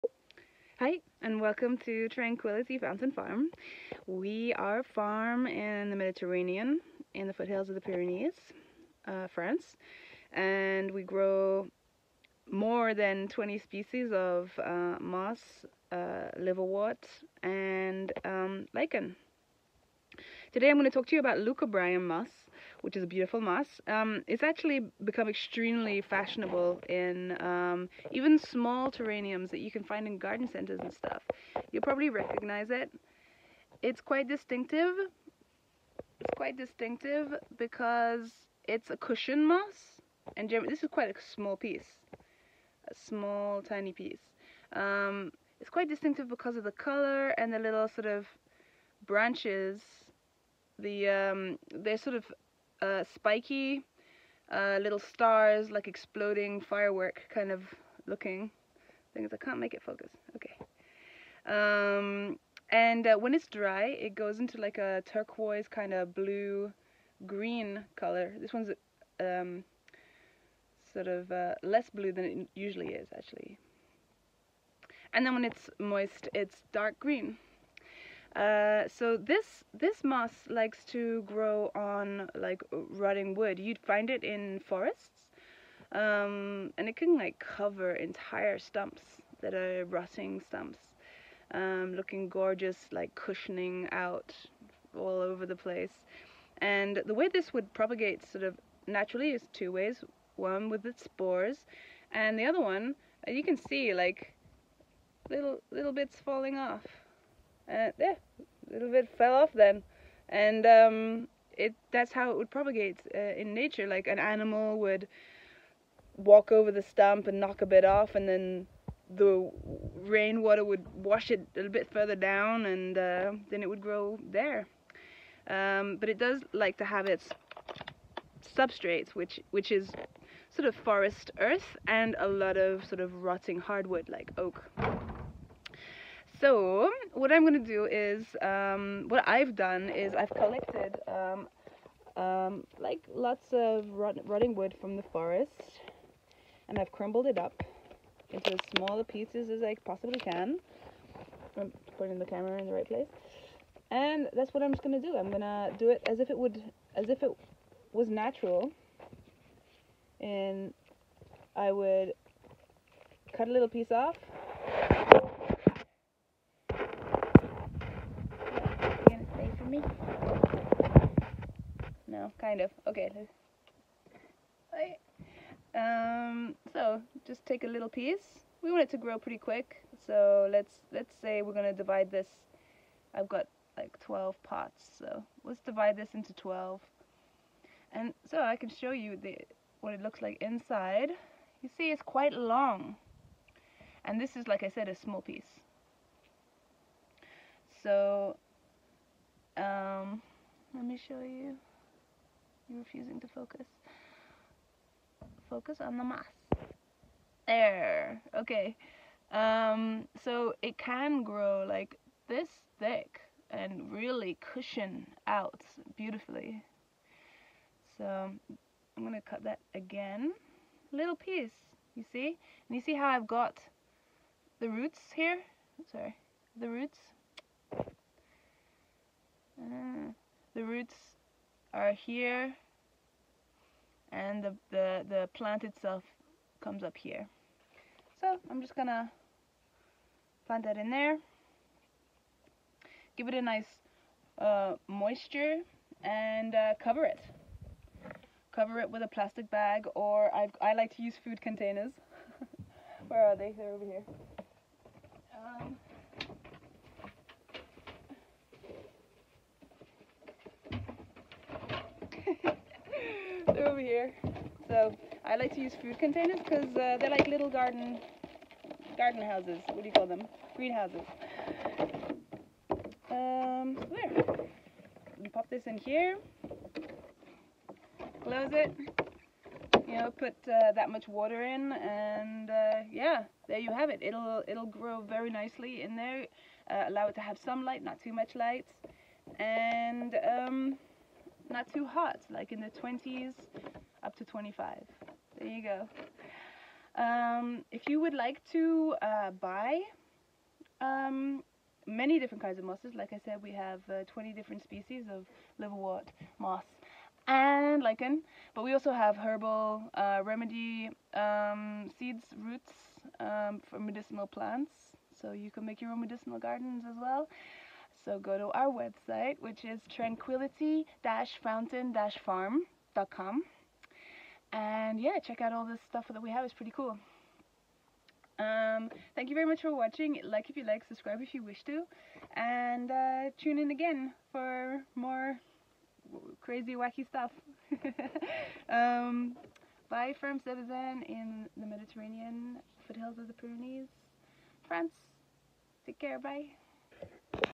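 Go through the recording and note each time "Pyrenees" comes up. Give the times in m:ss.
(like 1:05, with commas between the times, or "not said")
0:07, 5:43.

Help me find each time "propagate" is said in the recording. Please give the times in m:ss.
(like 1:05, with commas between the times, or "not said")
1:37, 1:52.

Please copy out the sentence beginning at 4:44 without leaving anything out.
It'll it'll grow very nicely in there.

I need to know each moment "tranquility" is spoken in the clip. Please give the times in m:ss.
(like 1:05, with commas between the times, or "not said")
0:02, 5:19.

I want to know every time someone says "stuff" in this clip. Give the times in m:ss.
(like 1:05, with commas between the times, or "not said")
0:30, 5:25, 5:37.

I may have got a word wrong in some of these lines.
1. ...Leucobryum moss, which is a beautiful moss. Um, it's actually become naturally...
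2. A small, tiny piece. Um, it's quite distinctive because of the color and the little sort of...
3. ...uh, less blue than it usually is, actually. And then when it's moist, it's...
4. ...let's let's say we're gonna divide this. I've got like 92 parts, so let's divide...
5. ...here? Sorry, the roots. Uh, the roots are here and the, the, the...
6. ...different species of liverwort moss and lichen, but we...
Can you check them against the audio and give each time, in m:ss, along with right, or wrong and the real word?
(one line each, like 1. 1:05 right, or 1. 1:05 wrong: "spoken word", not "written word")
1. 0:21 wrong: "extremely", not "naturally"
2. 0:42 right
3. 1:11 right
4. 3:00 wrong: "12", not "92"
5. 3:45 right
6. 5:04 right.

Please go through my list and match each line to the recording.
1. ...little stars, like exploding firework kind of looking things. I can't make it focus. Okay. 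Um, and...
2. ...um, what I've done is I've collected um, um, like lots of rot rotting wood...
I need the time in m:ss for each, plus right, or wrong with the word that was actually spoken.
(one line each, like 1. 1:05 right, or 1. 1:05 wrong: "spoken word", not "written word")
1. 0:54 right
2. 2:18 right.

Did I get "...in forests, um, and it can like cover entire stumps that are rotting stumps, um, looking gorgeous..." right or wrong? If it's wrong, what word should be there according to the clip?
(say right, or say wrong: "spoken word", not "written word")
right.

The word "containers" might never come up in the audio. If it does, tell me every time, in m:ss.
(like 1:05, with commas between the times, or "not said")
4:11, 4:25.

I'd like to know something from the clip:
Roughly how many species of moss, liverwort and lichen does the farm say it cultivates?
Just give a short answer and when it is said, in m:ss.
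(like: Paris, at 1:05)
more than 20, at 0:12.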